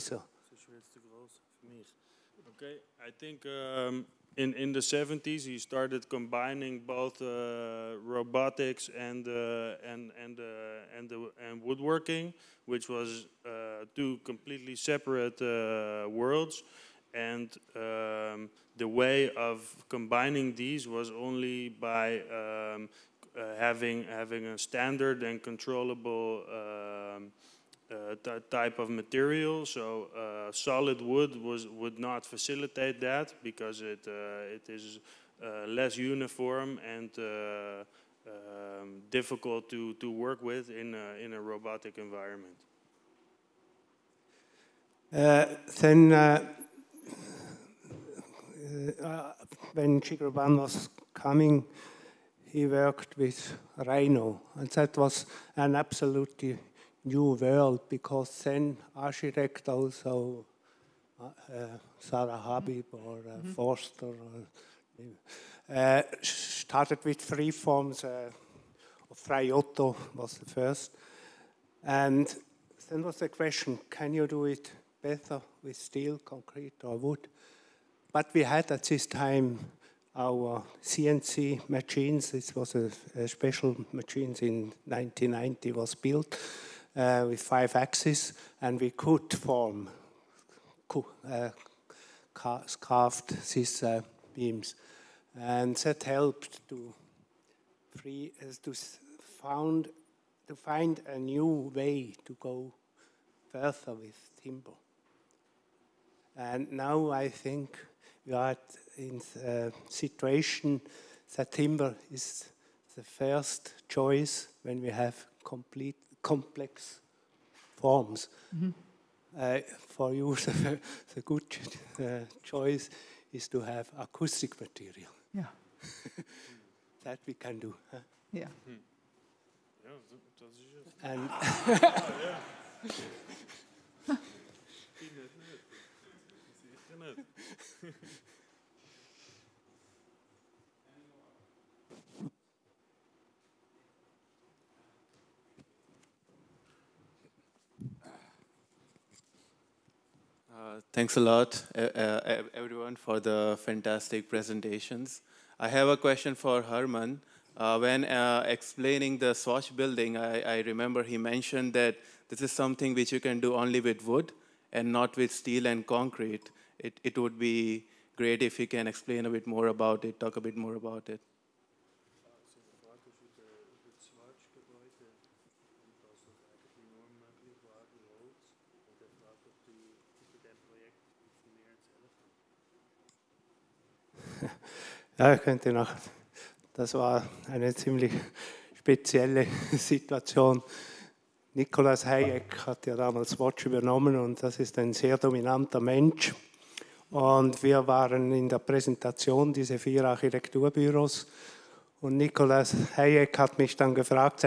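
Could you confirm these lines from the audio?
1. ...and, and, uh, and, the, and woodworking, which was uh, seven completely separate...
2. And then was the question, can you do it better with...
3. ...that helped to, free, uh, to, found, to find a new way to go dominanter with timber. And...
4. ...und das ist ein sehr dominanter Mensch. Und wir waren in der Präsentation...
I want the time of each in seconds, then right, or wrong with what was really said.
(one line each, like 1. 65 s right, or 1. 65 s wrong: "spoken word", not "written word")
1. 9 s wrong: "two", not "seven"
2. 71 s right
3. 95 s wrong: "further", not "dominanter"
4. 194 s right.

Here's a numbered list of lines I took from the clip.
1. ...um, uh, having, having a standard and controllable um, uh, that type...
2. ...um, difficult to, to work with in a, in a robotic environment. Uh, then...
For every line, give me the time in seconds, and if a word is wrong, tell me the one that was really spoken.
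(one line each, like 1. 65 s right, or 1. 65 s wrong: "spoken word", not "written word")
1. 22 s right
2. 37 s right.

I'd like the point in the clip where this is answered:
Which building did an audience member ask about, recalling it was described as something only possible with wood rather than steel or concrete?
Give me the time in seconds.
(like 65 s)
159 s.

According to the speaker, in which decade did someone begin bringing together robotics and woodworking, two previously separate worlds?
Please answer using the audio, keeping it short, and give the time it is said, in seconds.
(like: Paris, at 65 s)
the 70s, at 4 s.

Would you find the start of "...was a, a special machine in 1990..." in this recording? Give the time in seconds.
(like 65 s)
82 s.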